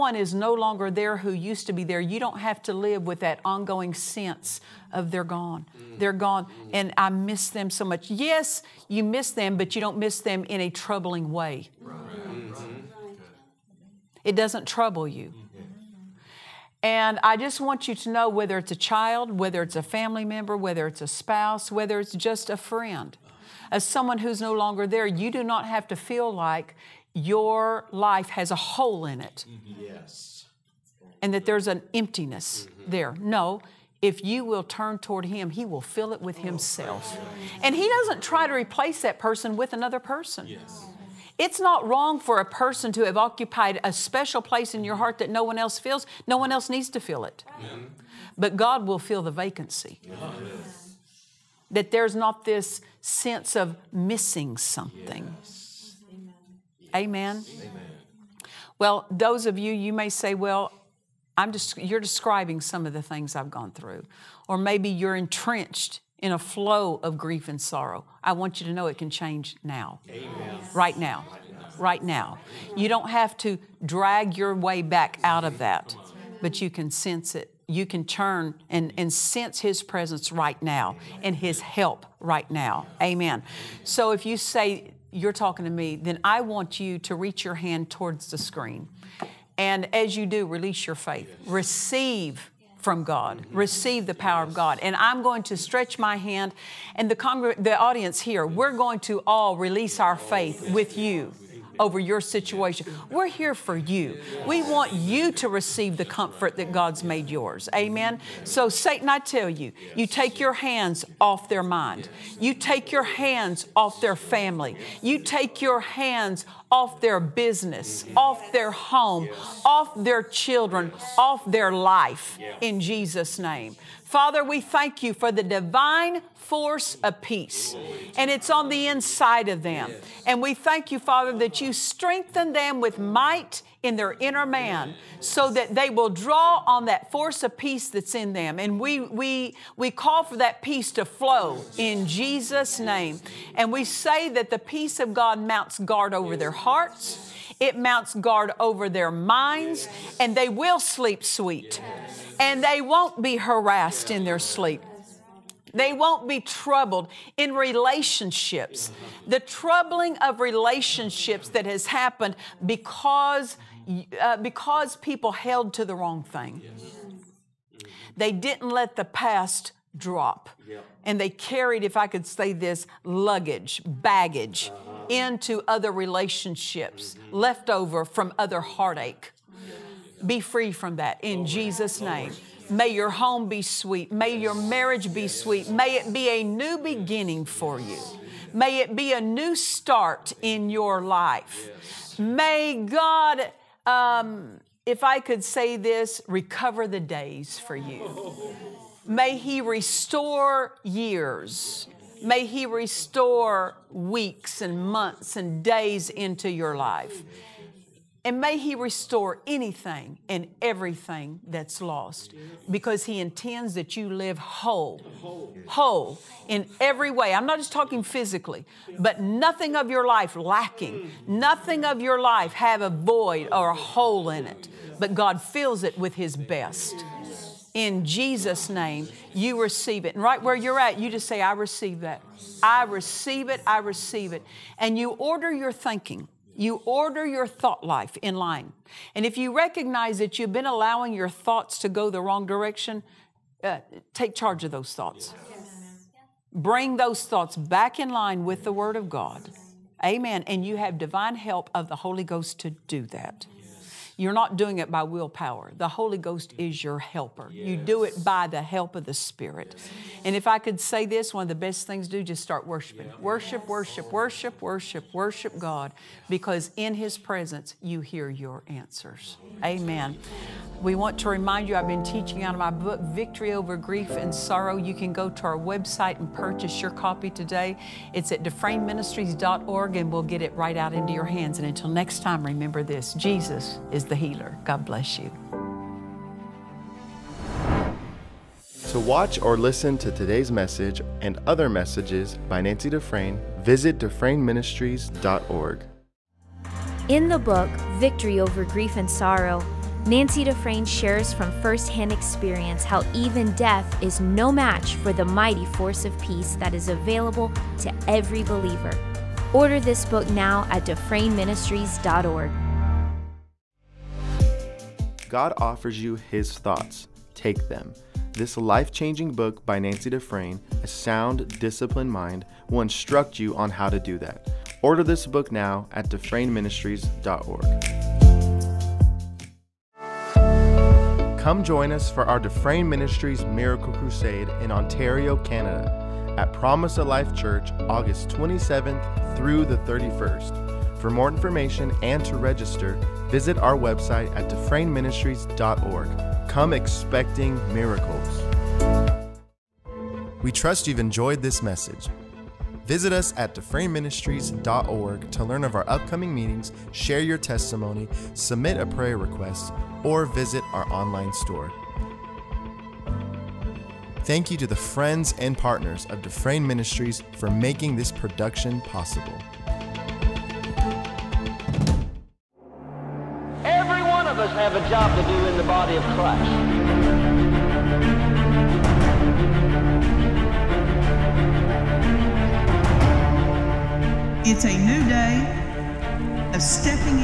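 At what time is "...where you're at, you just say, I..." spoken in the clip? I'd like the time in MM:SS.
03:50.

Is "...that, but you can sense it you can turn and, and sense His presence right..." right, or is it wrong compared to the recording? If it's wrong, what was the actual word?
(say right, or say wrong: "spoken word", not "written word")
right.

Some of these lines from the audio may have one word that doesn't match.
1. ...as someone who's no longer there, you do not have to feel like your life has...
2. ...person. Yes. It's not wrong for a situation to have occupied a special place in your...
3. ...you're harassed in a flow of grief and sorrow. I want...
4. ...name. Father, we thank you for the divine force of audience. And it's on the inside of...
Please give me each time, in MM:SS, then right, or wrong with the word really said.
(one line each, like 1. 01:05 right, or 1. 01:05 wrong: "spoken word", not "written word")
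1. 00:23 right
2. 00:39 wrong: "person", not "situation"
3. 01:04 wrong: "entrenched", not "harassed"
4. 02:03 wrong: "peace", not "audience".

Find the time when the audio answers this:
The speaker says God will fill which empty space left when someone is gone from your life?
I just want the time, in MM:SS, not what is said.
00:49.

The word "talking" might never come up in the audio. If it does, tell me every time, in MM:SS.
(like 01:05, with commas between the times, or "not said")
01:25, 03:37.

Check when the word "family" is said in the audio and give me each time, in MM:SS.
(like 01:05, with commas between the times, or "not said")
00:19, 01:54.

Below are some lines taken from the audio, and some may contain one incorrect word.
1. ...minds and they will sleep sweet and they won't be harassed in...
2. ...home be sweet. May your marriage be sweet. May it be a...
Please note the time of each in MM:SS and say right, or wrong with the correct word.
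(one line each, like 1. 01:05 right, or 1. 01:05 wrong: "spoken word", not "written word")
1. 02:29 right
2. 03:03 right.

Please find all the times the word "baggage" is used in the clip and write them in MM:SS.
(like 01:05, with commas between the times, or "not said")
02:53.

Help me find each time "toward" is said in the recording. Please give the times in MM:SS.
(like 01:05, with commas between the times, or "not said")
00:34, 01:27.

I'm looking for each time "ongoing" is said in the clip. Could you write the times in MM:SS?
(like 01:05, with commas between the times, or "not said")
00:03.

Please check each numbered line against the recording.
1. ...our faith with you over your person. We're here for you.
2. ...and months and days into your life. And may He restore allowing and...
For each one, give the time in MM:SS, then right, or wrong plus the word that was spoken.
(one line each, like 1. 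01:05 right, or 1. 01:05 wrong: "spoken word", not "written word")
1. 01:40 wrong: "situation", not "person"
2. 03:24 wrong: "anything", not "allowing".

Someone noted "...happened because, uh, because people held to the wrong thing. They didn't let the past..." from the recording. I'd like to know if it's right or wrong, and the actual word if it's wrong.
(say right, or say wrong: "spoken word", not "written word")
right.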